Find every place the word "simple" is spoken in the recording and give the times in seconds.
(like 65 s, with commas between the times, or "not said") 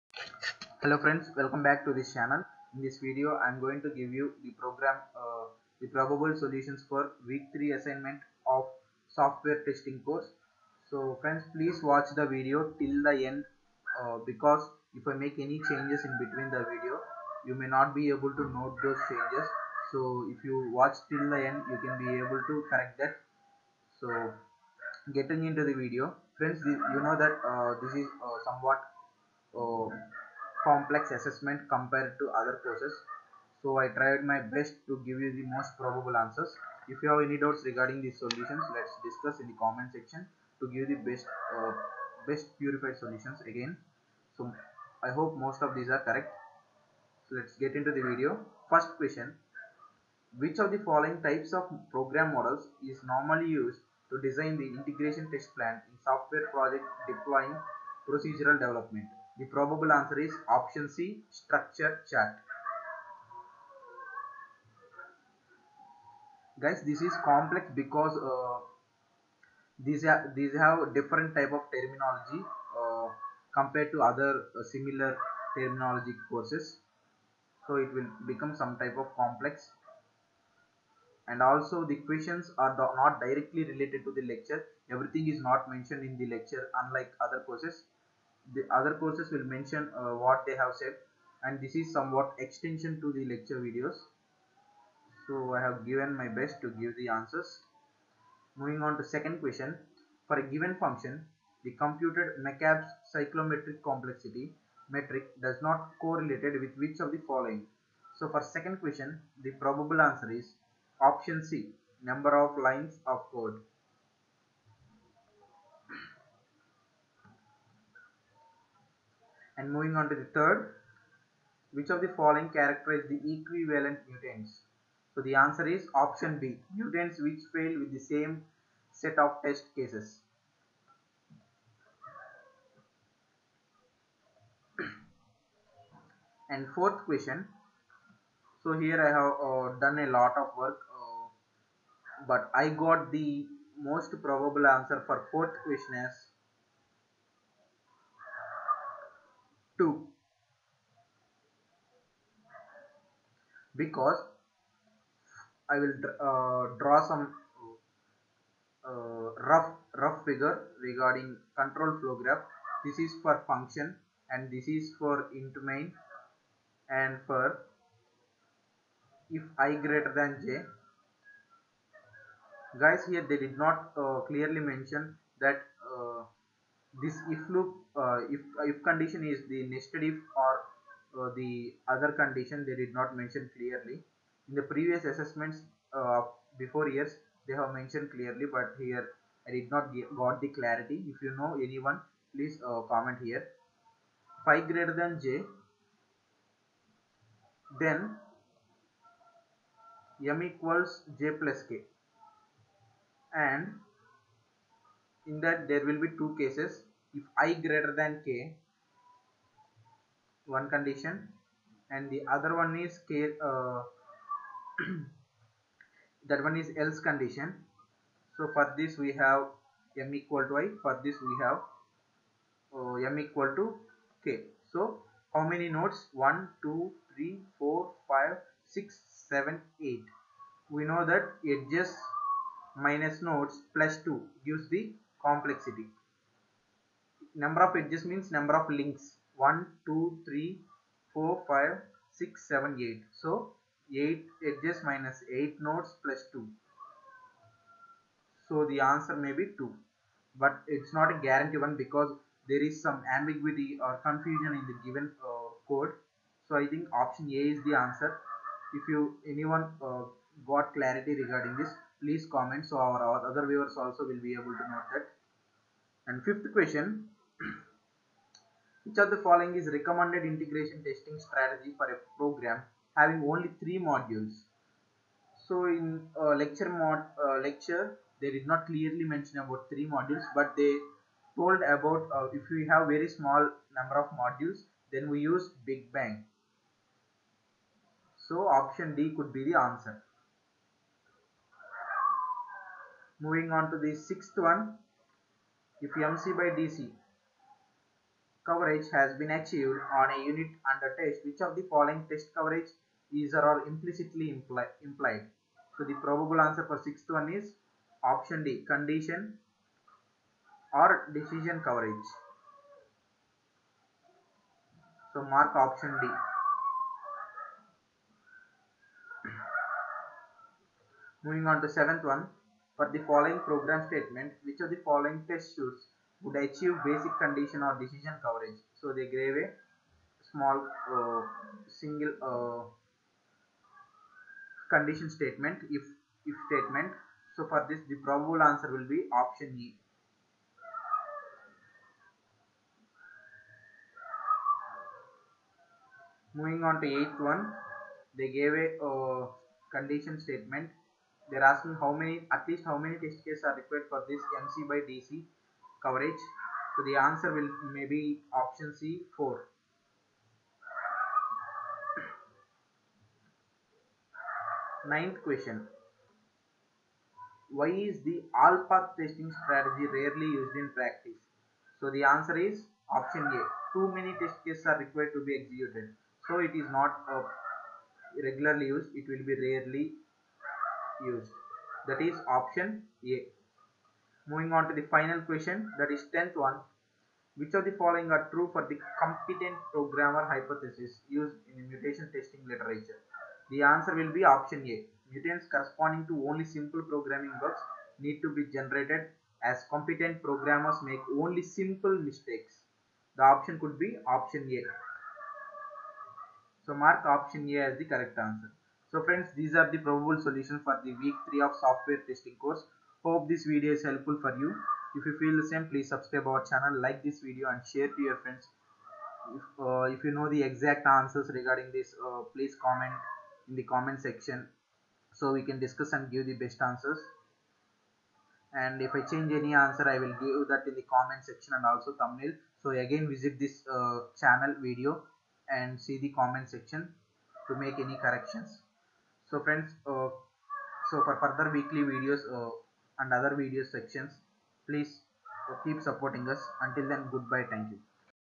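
396 s, 401 s.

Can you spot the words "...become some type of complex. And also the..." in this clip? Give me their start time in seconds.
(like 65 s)
78 s.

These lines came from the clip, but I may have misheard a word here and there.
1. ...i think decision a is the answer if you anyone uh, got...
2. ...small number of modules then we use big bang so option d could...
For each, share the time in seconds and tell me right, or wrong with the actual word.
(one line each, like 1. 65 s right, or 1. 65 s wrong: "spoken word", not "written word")
1. 256 s wrong: "option", not "decision"
2. 283 s right.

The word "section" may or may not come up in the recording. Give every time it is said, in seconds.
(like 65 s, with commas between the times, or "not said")
39 s, 424 s, 431 s, 436 s, 443 s.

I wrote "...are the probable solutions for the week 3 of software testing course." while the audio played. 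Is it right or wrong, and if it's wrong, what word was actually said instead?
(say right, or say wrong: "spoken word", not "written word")
right.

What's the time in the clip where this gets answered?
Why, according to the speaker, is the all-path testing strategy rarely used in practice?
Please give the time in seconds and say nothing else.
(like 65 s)
373 s.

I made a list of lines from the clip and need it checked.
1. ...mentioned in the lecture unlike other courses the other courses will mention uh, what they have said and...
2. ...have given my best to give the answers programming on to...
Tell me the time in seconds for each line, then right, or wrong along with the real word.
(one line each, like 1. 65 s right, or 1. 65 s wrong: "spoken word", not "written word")
1. 85 s right
2. 95 s wrong: "moving", not "programming".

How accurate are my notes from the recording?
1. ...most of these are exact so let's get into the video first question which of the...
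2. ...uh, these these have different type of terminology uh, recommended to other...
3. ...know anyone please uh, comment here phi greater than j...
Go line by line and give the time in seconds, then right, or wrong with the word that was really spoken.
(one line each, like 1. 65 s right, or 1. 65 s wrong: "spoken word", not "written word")
1. 45 s wrong: "correct", not "exact"
2. 68 s wrong: "compared", not "recommended"
3. 191 s right.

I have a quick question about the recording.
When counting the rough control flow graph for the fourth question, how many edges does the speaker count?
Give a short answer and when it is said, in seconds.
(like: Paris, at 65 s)
8, at 244 s.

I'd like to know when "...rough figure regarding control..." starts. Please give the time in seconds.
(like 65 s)
160 s.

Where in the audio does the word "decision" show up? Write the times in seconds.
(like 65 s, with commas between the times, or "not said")
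311 s, 327 s.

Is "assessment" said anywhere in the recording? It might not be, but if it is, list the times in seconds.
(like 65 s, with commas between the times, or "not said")
31 s, 185 s.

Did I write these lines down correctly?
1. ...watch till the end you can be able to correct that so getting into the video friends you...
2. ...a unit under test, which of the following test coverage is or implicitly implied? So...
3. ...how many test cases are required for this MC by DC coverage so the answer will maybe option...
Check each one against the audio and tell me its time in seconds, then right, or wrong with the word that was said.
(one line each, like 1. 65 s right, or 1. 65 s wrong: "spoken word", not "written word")
1. 20 s right
2. 300 s right
3. 352 s right.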